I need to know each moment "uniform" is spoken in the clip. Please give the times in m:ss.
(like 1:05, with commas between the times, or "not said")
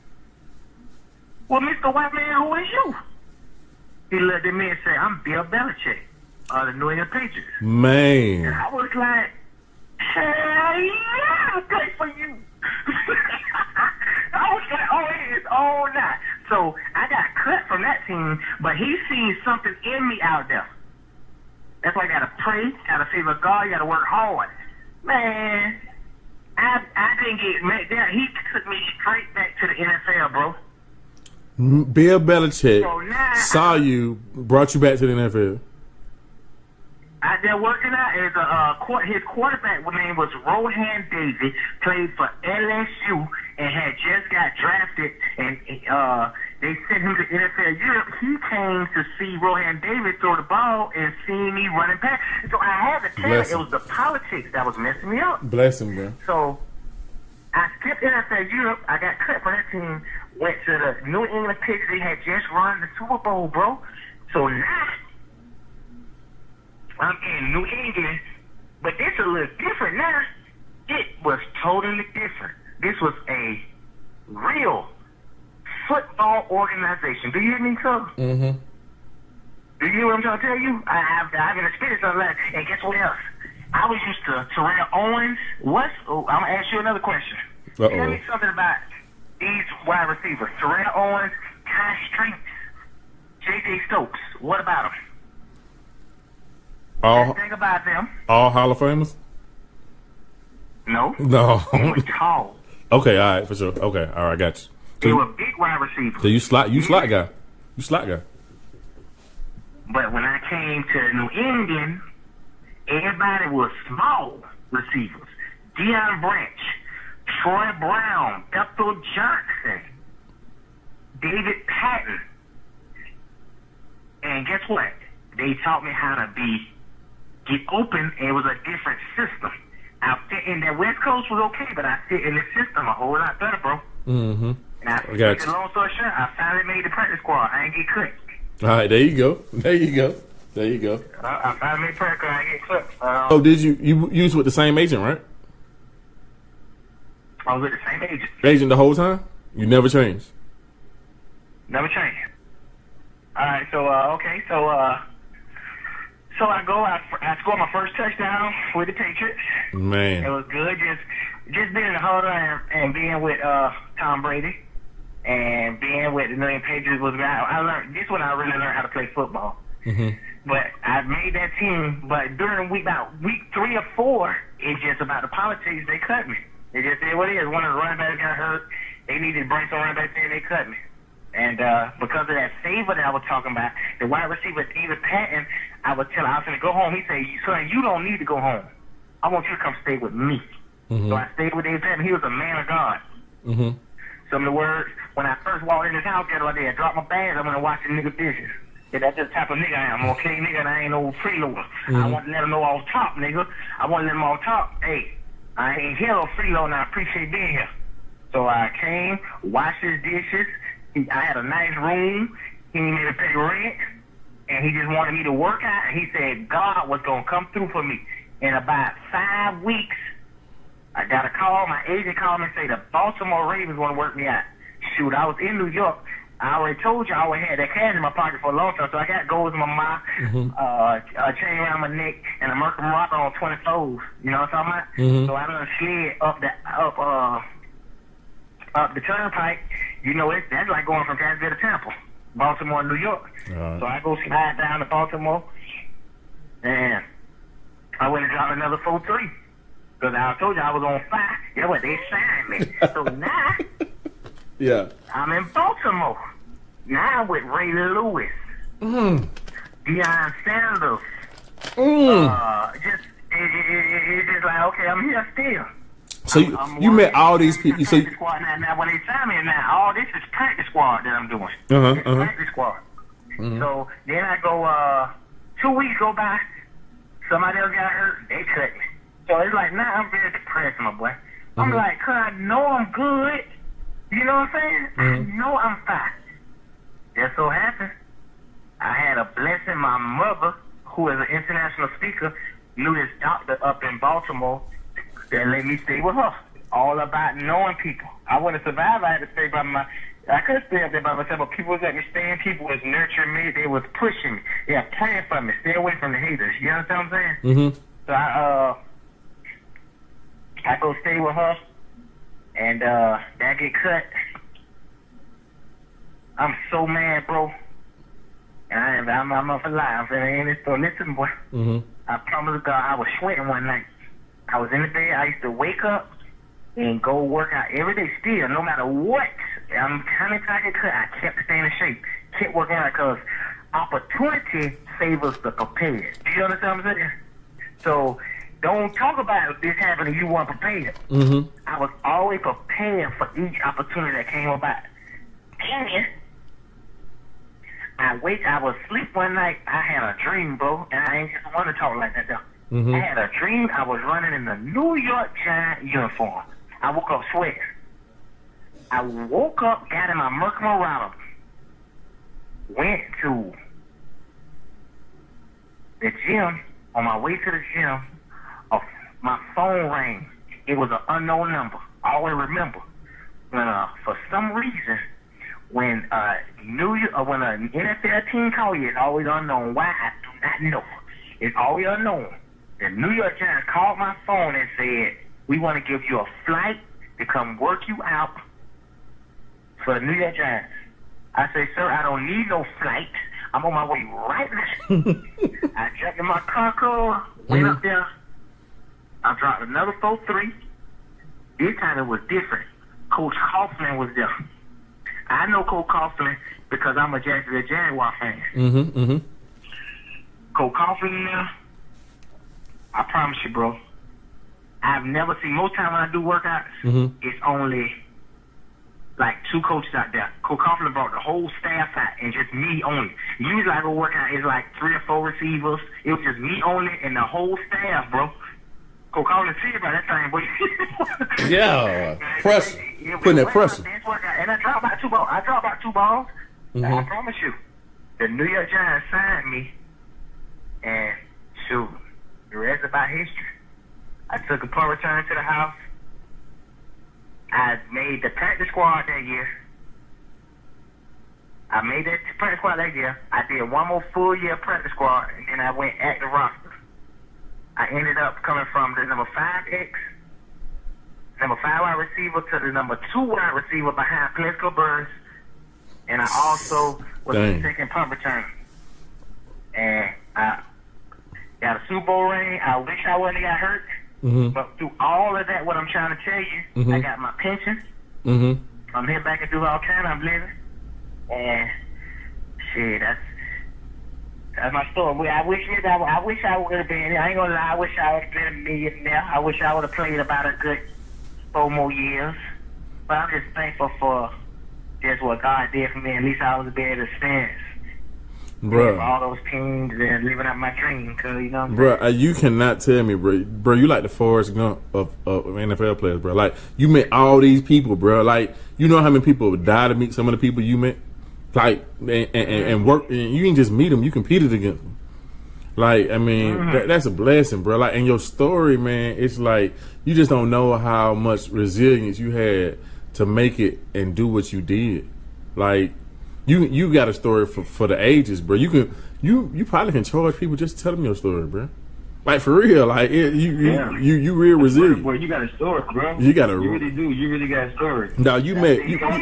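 5:55.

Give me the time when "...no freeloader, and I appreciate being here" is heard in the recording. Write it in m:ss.
3:26.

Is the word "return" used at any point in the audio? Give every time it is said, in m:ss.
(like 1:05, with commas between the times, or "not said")
7:24, 7:48.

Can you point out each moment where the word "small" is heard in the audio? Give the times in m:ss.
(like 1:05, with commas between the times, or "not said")
1:53.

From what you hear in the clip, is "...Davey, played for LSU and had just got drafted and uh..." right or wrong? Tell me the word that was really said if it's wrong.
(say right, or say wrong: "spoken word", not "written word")
right.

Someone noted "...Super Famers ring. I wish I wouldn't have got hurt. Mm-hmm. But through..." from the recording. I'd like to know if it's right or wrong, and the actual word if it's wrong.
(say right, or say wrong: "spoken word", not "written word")
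wrong: "Bowl", not "Famers".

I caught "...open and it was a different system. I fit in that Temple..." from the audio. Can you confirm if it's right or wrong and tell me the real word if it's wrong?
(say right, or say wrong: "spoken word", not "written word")
wrong: "West", not "Temple".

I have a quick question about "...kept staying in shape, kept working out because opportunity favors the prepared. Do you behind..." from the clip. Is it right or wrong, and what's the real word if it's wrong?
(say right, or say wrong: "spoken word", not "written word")
wrong: "understand", not "behind".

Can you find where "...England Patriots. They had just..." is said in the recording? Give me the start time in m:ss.
1:01.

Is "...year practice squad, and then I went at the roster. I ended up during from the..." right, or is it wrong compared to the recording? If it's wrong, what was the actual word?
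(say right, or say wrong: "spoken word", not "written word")
wrong: "coming", not "during".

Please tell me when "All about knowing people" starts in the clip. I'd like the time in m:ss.
4:56.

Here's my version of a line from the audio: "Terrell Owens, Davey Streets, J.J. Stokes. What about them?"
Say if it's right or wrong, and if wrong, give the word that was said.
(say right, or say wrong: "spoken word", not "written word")
wrong: "Tai", not "Davey".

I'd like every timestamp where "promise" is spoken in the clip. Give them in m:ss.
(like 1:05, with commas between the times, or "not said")
5:22, 6:53, 7:17.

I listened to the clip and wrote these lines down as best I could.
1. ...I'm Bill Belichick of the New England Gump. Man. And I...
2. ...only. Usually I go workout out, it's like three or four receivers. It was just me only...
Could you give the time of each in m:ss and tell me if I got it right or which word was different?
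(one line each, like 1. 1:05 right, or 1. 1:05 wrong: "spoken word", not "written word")
1. 0:04 wrong: "Patriots", not "Gump"
2. 7:02 right.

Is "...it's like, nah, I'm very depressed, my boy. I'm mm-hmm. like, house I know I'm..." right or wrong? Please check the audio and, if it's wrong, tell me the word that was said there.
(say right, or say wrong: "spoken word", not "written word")
wrong: "cause", not "house".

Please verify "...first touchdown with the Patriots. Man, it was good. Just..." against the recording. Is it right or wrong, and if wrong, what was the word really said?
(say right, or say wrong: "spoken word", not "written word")
right.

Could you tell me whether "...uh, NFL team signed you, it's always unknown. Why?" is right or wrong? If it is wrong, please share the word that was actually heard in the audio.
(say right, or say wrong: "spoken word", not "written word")
wrong: "called", not "signed".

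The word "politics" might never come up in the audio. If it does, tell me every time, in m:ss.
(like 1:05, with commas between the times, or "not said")
0:53, 2:55.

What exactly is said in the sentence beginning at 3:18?
Yeah, that's just the type of nigga I am, okay, nigga, and I ain't no freeloader.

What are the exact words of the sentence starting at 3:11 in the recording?
So I stayed with David Patten.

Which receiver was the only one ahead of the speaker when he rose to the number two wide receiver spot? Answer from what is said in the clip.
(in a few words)
Plaxico Burress.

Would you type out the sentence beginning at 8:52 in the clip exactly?
Like for real, like it, you, you, you you real resilient.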